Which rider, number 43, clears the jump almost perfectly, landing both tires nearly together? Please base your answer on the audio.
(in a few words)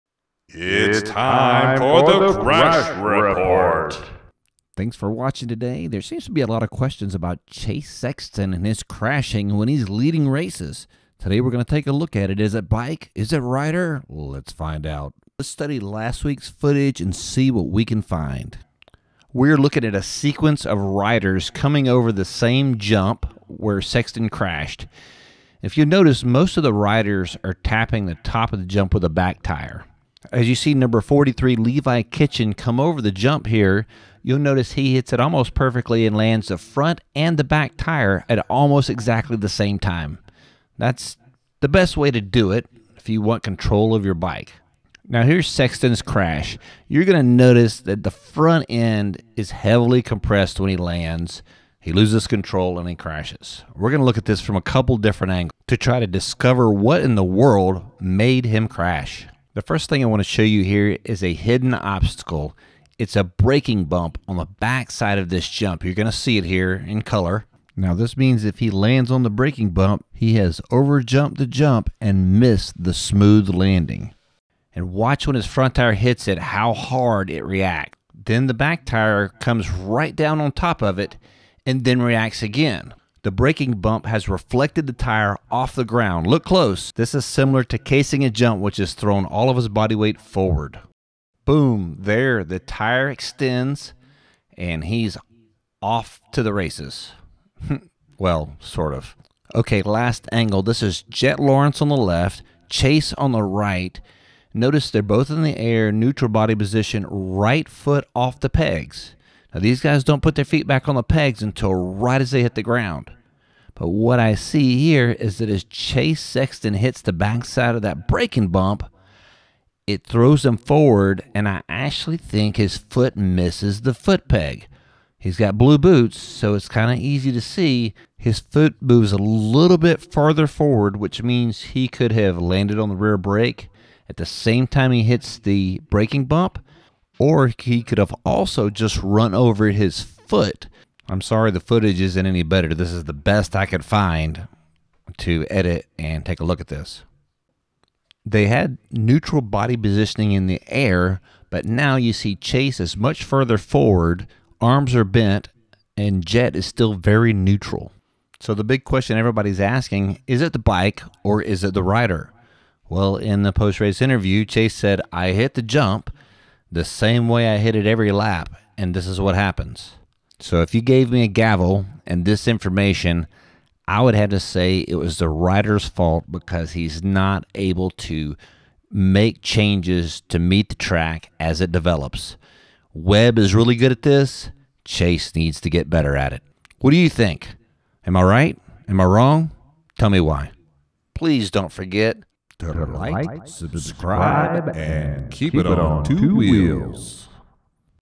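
Levi Kitchen.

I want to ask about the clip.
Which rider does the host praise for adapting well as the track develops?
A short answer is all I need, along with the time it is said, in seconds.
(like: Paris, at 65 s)
Webb, at 182 s.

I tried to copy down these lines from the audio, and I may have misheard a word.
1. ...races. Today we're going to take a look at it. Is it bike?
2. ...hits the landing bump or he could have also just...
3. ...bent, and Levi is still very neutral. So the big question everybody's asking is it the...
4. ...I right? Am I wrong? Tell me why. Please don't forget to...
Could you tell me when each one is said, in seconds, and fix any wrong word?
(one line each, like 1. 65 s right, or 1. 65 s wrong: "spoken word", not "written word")
1. 10 s right
2. 135 s wrong: "braking", not "landing"
3. 155 s wrong: "Jett", not "Levi"
4. 188 s right.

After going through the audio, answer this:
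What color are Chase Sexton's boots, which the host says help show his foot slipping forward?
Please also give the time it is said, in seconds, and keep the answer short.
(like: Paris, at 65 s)
Blue, at 125 s.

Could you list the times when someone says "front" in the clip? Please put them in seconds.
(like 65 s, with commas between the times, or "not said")
36 s, 48 s, 75 s.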